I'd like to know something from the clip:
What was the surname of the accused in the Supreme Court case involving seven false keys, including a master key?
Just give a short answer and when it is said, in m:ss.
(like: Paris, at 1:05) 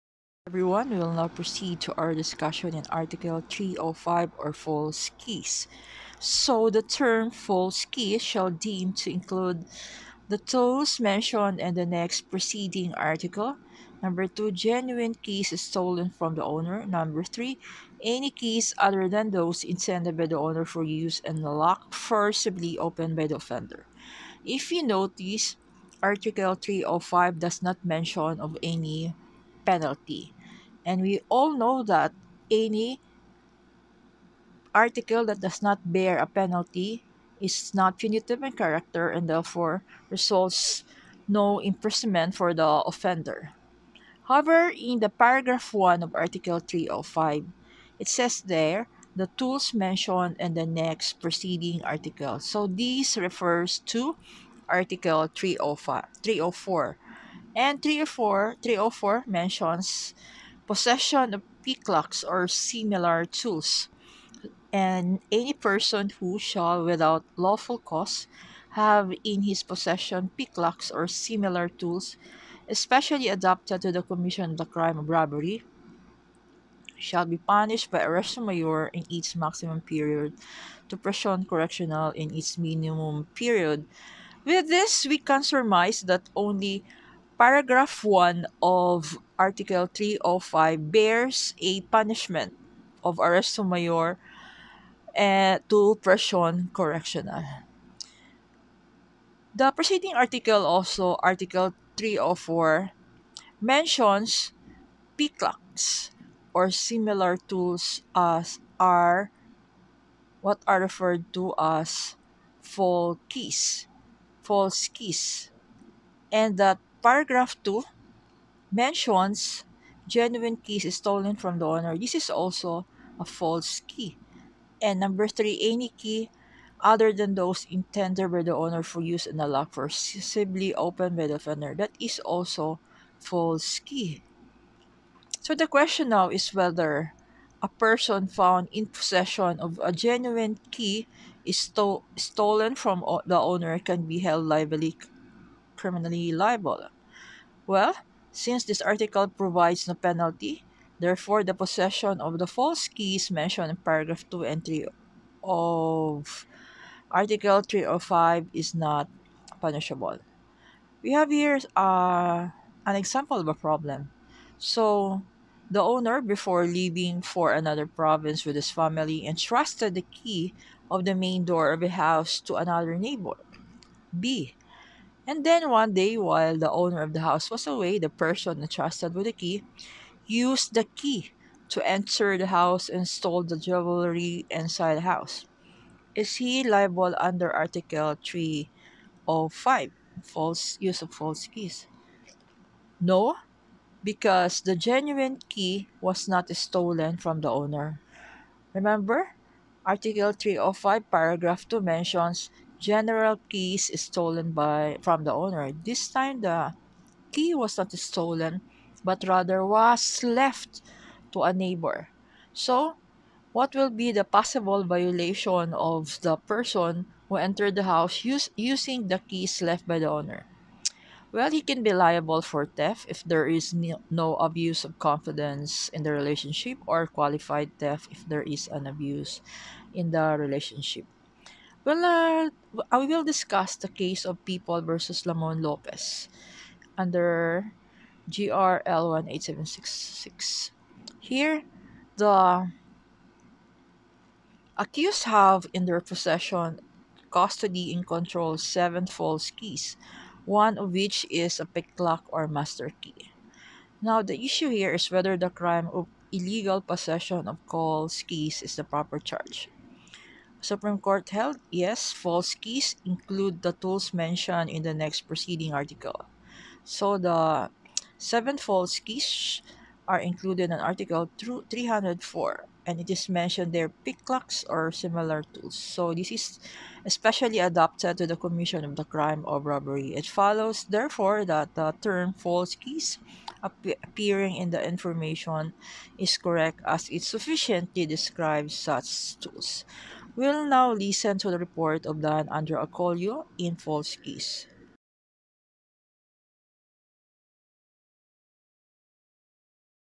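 Lopez, at 3:55.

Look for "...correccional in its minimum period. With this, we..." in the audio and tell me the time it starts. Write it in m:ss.
1:21.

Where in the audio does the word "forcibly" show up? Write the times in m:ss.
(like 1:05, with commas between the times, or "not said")
0:21, 2:09.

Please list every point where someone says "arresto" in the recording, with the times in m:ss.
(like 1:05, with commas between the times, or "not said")
1:17, 1:33.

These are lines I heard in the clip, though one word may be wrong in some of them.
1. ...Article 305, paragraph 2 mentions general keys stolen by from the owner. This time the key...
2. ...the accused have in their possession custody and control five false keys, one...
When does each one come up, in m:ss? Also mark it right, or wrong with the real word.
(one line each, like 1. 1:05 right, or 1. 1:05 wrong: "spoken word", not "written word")
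1. 3:19 right
2. 4:02 wrong: "seven", not "five".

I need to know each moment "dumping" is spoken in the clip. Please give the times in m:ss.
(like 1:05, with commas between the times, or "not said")
not said.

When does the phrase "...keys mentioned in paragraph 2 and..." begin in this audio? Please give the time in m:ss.
2:32.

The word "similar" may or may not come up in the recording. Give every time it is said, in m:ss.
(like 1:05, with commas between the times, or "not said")
1:02, 1:11, 1:46, 4:34.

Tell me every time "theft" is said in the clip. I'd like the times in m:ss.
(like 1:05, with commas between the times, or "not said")
3:42, 3:47.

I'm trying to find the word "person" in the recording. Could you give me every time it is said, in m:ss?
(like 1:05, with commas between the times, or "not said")
1:05, 2:17, 2:58, 3:36.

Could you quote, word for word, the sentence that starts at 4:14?
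Now, the issue here is whether the crime of illegal possession of false keys is the proper charge.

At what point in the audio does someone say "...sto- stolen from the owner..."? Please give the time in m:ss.
2:21.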